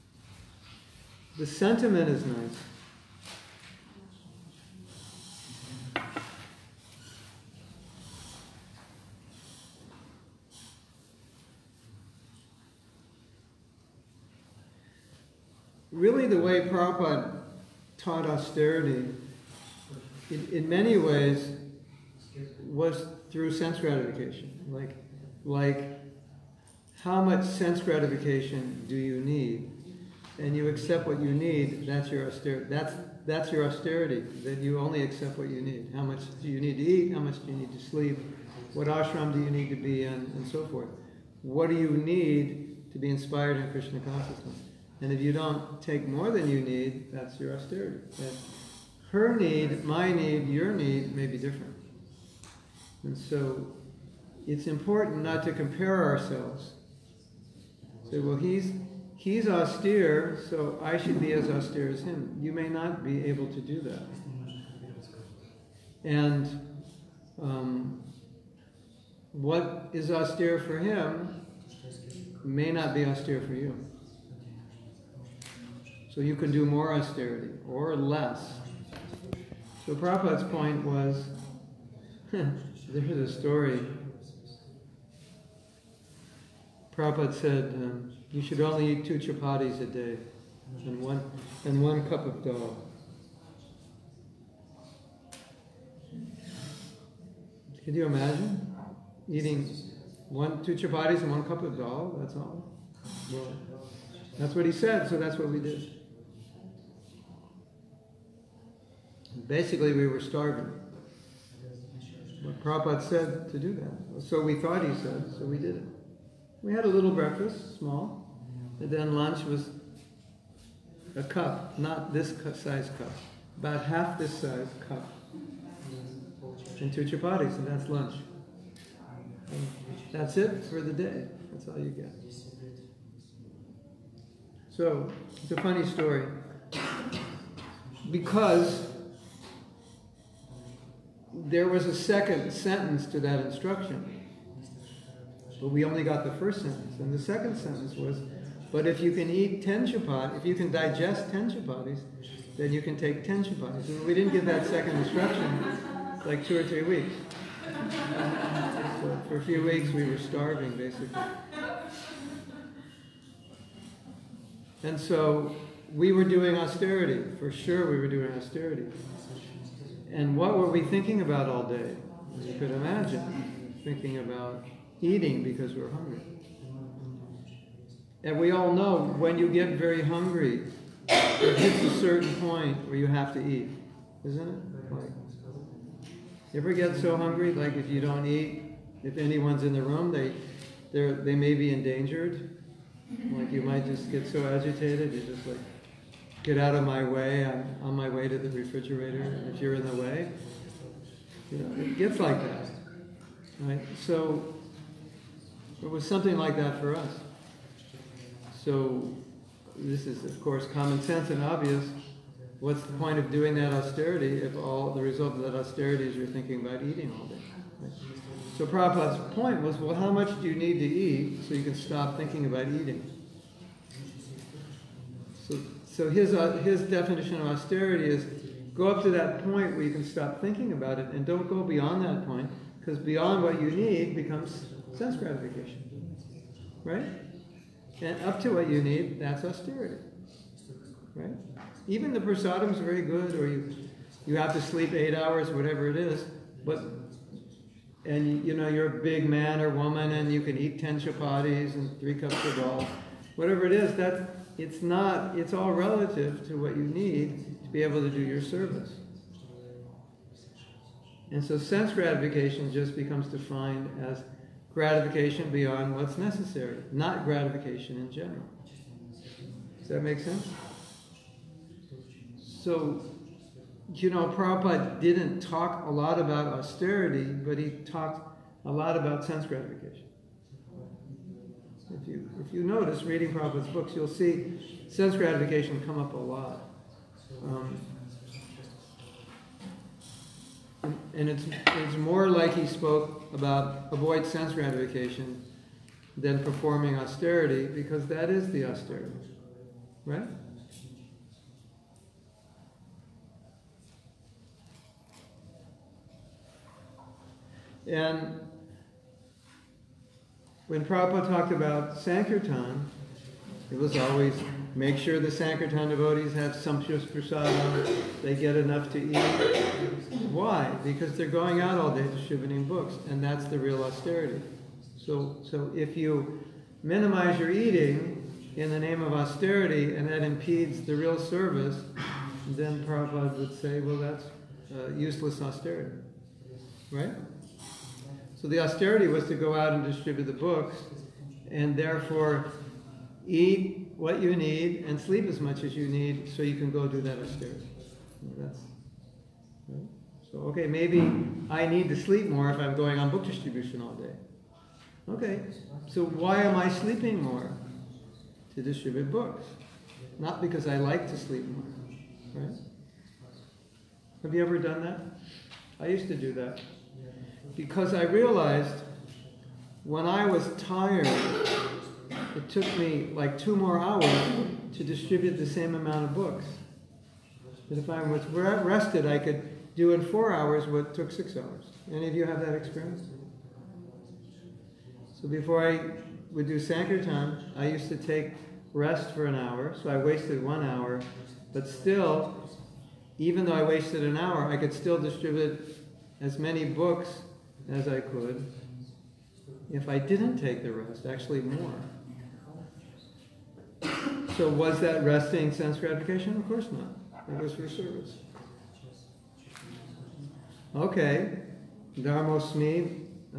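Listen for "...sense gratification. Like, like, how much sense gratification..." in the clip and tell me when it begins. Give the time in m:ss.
0:23.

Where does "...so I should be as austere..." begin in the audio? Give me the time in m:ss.
1:00.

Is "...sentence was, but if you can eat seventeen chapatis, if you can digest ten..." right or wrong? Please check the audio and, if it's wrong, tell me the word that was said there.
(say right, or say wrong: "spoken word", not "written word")
wrong: "ten", not "seventeen".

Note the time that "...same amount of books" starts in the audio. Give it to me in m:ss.
6:15.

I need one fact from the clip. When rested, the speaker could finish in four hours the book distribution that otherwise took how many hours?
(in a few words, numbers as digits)
6.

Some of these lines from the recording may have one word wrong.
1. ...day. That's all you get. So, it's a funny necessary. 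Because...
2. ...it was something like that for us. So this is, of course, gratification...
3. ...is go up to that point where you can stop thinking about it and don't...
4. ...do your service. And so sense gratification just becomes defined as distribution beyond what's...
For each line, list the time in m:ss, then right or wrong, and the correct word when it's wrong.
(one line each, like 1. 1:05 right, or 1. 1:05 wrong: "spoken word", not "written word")
1. 2:10 wrong: "story", not "necessary"
2. 3:25 wrong: "common", not "gratification"
3. 3:48 right
4. 4:18 wrong: "gratification", not "distribution".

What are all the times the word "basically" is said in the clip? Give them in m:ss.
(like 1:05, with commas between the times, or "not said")
1:49, 2:40.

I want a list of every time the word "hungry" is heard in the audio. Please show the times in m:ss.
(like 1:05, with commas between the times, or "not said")
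2:55, 3:00, 3:07.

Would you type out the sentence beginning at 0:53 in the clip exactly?
And so it's important not to compare ourselves.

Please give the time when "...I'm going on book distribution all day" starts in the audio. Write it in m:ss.
5:52.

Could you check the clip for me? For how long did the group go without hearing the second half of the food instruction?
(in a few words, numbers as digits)
two or three weeks.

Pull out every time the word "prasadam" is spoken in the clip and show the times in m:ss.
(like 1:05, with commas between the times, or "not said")
4:02, 5:17.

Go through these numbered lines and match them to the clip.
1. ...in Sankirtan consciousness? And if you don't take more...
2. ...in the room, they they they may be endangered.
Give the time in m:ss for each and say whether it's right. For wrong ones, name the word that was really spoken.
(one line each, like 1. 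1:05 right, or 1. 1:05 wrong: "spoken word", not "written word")
1. 0:43 wrong: "Krishna", not "Sankirtan"
2. 3:09 right.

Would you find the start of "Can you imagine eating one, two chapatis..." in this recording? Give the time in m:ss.
1:37.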